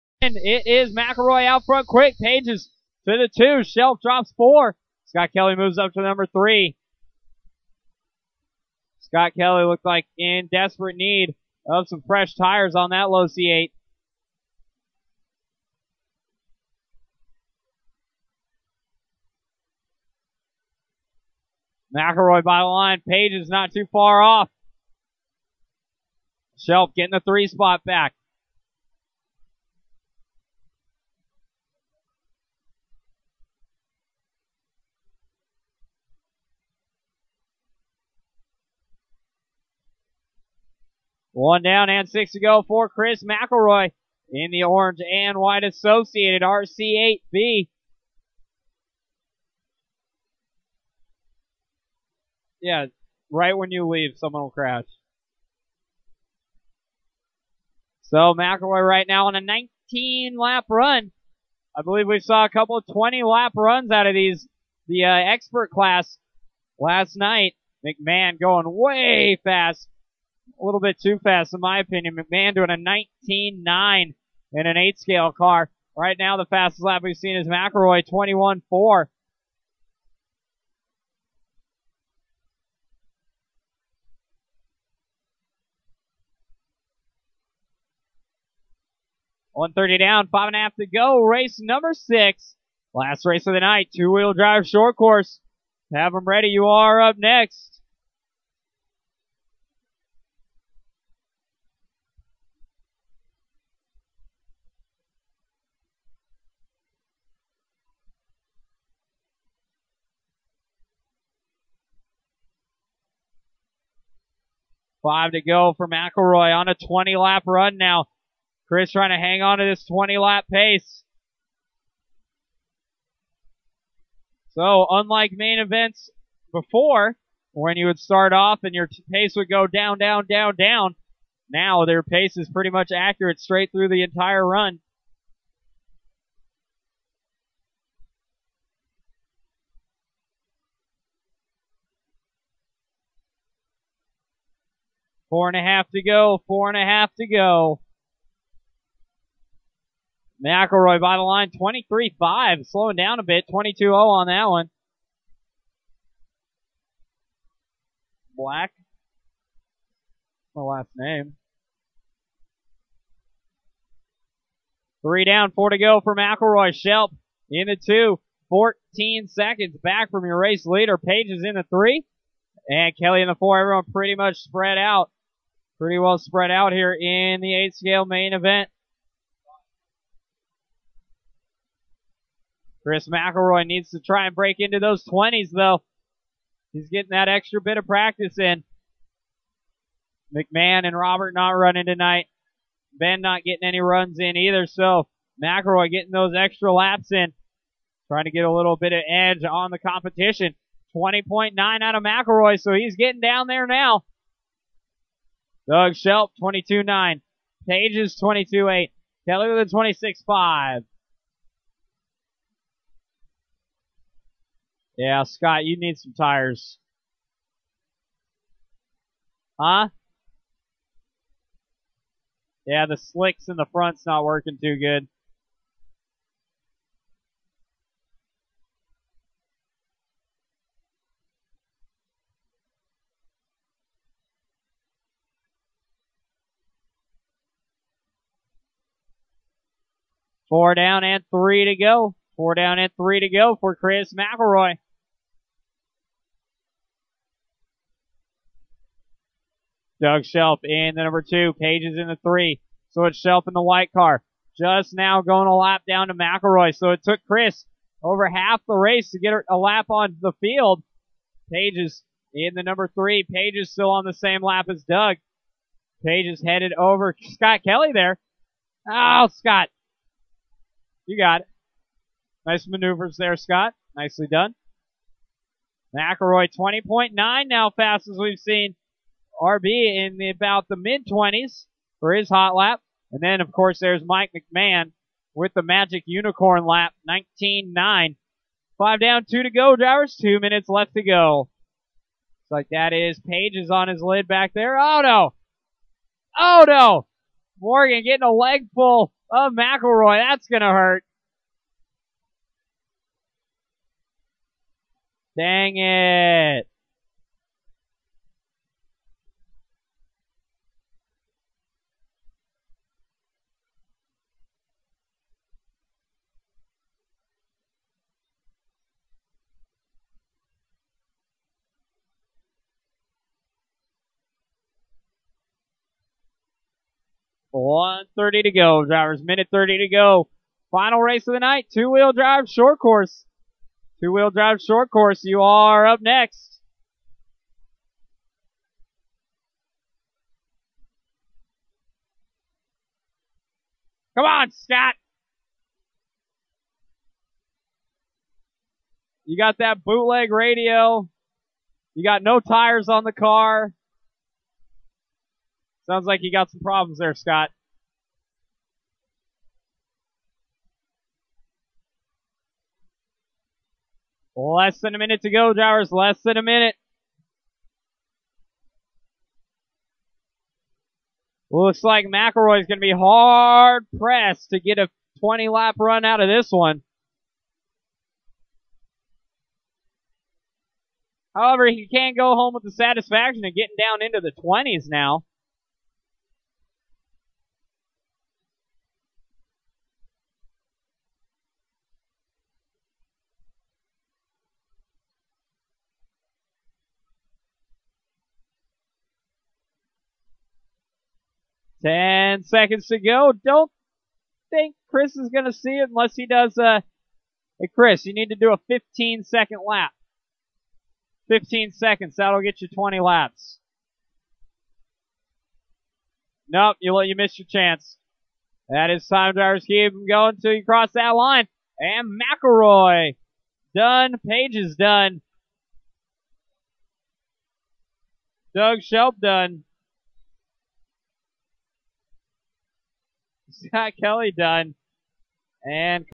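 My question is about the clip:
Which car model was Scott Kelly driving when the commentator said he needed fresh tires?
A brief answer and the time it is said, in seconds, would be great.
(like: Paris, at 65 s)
Losi 8, at 13 s.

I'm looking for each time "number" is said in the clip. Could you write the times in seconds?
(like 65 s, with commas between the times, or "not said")
6 s, 91 s, 251 s, 262 s.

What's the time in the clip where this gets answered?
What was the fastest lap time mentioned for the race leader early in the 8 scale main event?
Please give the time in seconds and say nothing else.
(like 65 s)
78 s.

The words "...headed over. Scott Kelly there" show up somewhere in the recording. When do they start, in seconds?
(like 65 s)
266 s.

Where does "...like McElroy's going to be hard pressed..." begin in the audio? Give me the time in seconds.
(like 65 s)
371 s.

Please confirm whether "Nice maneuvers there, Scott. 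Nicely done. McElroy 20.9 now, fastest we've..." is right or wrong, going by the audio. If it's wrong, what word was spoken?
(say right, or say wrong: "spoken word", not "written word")
right.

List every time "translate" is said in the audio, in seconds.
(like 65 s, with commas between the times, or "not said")
not said.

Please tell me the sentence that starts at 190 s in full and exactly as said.
McMahon and Robert not running tonight.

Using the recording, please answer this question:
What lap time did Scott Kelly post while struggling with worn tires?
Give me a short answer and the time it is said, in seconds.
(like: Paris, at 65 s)
26.5, at 210 s.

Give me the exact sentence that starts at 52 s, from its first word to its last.
Yeah, right when you leave, someone will crash.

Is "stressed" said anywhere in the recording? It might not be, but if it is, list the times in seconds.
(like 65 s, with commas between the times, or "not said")
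not said.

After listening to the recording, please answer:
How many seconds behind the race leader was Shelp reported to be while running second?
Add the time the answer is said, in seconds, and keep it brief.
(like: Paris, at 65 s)
14, at 168 s.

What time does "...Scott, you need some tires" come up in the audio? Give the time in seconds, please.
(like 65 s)
215 s.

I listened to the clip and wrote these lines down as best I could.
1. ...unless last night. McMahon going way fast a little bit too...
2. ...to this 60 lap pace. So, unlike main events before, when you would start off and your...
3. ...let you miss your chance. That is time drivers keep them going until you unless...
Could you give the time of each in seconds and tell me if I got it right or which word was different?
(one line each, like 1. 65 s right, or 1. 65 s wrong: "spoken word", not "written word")
1. 65 s wrong: "class", not "unless"
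2. 119 s wrong: "20", not "60"
3. 416 s wrong: "cross", not "unless".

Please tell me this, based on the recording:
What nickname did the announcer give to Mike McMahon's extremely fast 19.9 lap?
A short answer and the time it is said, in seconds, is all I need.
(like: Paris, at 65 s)
Magic Unicorn lap, at 285 s.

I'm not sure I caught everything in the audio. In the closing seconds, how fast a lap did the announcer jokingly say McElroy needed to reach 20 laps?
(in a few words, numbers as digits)
15 seconds.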